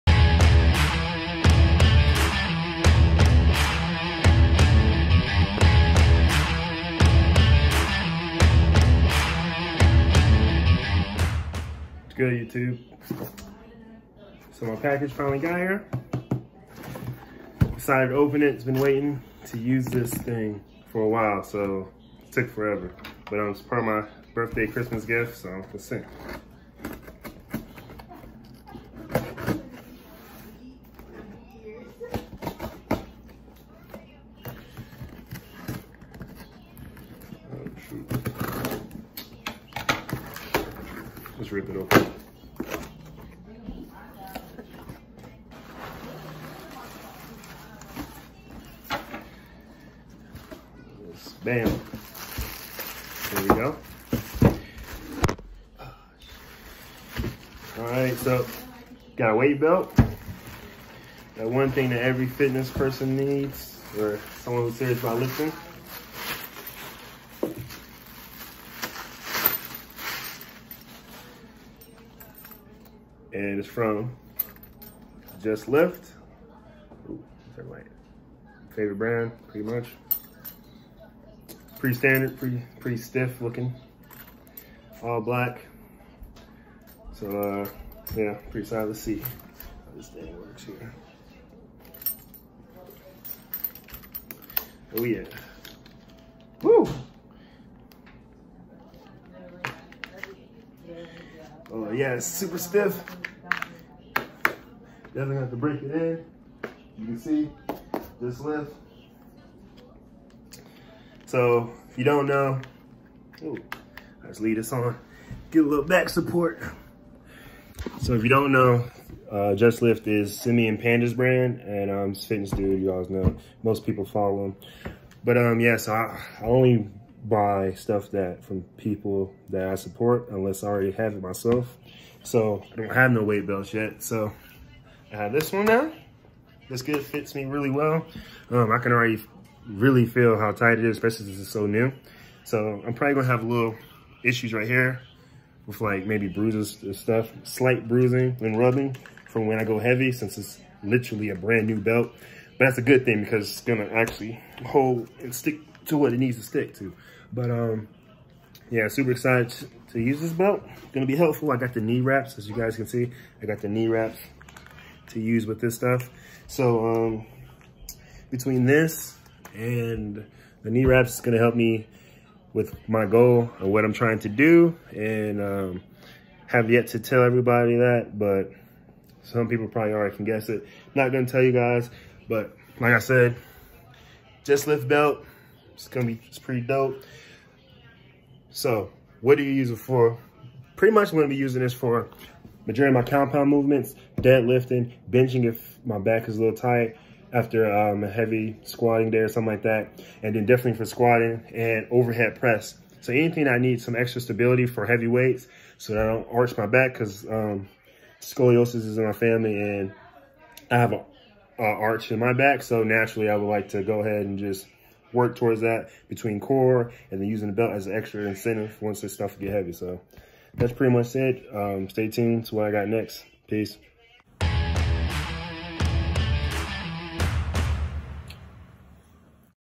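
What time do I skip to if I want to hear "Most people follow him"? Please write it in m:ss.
2:03.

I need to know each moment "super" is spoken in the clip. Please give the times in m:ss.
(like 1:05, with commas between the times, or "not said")
1:42, 2:38.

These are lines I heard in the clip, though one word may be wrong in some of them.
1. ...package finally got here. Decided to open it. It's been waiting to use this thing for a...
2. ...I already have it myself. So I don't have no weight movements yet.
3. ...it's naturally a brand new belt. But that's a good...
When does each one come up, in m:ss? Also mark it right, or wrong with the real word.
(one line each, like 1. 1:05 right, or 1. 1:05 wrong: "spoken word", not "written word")
1. 0:14 right
2. 2:10 wrong: "belts", not "movements"
3. 2:30 wrong: "literally", not "naturally".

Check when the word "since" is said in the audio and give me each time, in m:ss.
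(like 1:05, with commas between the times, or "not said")
2:21, 2:30.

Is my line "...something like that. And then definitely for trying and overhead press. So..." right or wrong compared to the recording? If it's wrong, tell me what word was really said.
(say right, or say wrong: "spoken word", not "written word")
wrong: "squatting", not "trying".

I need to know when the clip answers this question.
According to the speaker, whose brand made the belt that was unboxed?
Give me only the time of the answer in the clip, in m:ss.
2:00.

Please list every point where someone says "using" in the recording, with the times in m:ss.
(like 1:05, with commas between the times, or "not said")
3:11, 3:37.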